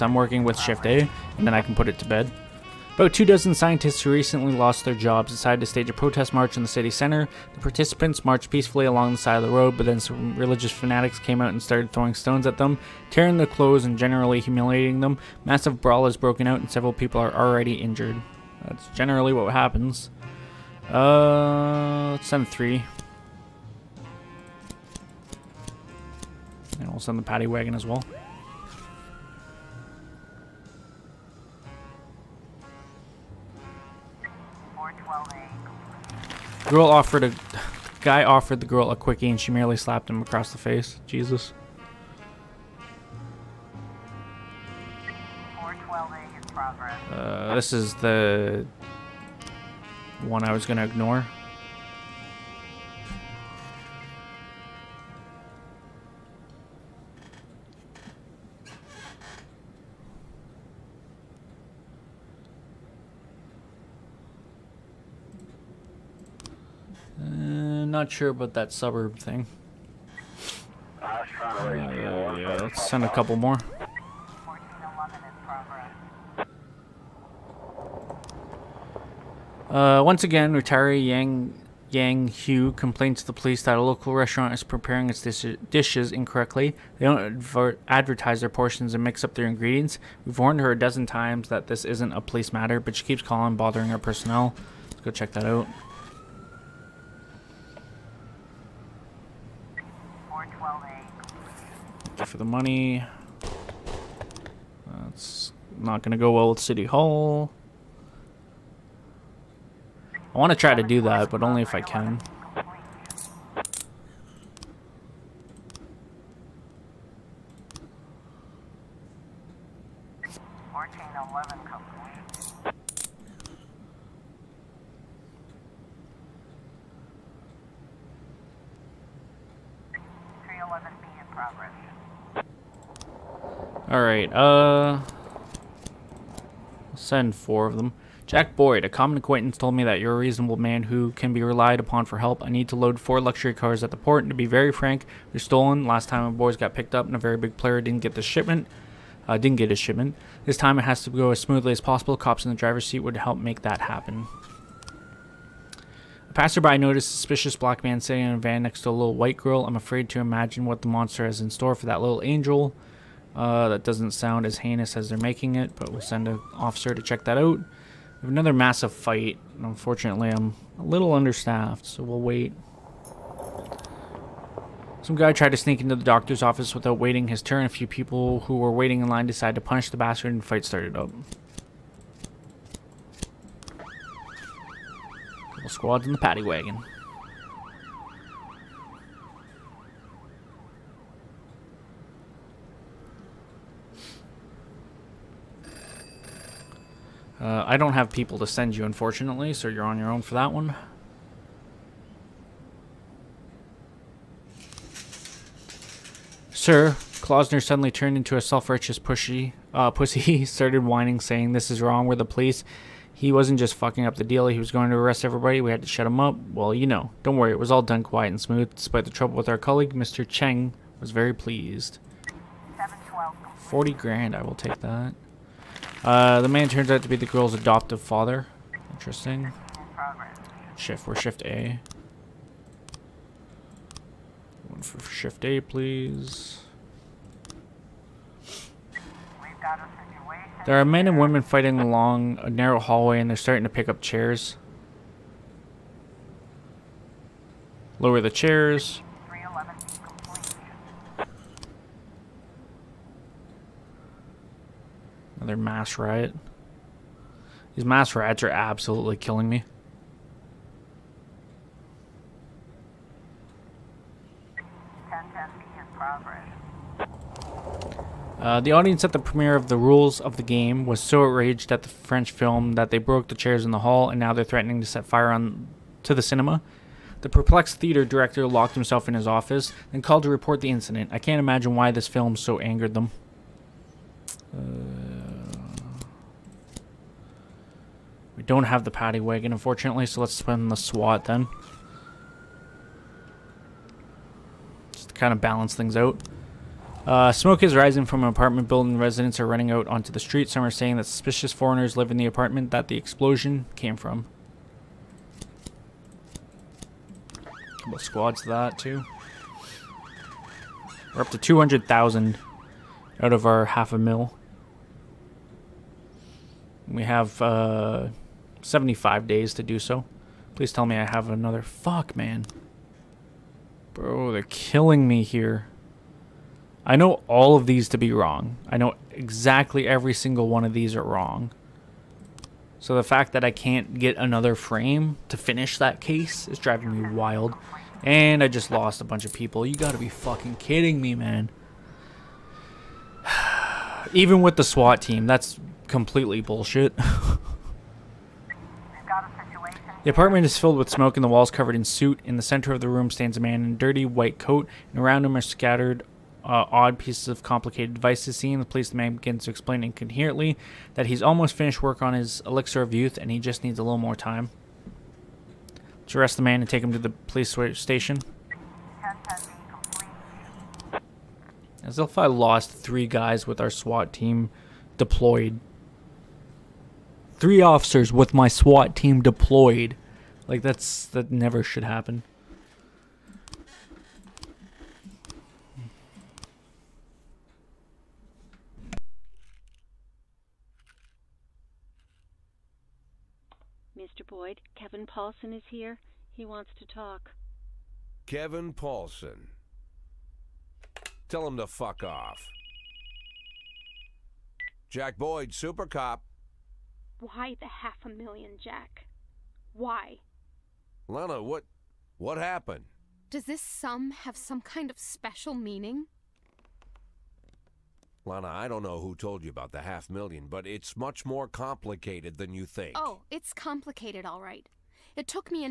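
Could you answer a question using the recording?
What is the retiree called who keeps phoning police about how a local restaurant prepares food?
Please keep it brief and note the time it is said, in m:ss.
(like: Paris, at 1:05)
Yang Yang Hu, at 1:21.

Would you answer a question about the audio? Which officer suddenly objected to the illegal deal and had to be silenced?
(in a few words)
Klausner.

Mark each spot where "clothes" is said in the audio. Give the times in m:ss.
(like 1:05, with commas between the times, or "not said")
0:13.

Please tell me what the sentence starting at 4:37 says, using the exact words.
The perplexed theater director locked himself in his office and called to report the incident.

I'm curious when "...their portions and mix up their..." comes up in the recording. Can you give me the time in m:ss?
1:28.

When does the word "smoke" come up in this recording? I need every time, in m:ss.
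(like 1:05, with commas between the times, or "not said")
4:57, 5:50.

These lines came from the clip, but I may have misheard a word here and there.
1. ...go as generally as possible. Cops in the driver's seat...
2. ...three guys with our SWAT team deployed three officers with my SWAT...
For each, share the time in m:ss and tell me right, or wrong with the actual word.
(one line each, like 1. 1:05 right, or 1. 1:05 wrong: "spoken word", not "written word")
1. 2:31 wrong: "smoothly", not "generally"
2. 6:12 right.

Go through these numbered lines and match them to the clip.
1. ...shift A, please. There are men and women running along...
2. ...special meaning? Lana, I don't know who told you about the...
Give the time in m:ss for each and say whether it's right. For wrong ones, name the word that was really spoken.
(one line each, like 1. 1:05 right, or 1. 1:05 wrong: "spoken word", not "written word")
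1. 3:55 wrong: "fighting", not "running"
2. 6:54 right.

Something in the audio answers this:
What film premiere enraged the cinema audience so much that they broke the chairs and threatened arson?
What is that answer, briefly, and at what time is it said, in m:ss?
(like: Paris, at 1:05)
The Rules of the Game, at 4:29.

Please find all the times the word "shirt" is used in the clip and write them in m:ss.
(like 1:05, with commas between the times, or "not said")
not said.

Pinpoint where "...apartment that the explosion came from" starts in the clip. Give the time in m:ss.
5:02.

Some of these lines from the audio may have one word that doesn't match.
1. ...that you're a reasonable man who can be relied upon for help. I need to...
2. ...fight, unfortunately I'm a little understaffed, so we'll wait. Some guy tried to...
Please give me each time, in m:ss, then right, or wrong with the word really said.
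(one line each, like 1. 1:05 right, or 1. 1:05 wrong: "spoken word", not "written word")
1. 2:19 right
2. 2:48 right.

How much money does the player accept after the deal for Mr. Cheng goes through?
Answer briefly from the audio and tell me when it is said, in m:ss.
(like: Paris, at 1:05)
40 grand, at 3:43.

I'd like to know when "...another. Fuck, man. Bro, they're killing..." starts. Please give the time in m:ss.
5:21.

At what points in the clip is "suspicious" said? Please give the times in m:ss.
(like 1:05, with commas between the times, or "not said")
2:37, 5:01.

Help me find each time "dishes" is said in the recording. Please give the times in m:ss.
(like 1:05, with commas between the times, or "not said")
1:25.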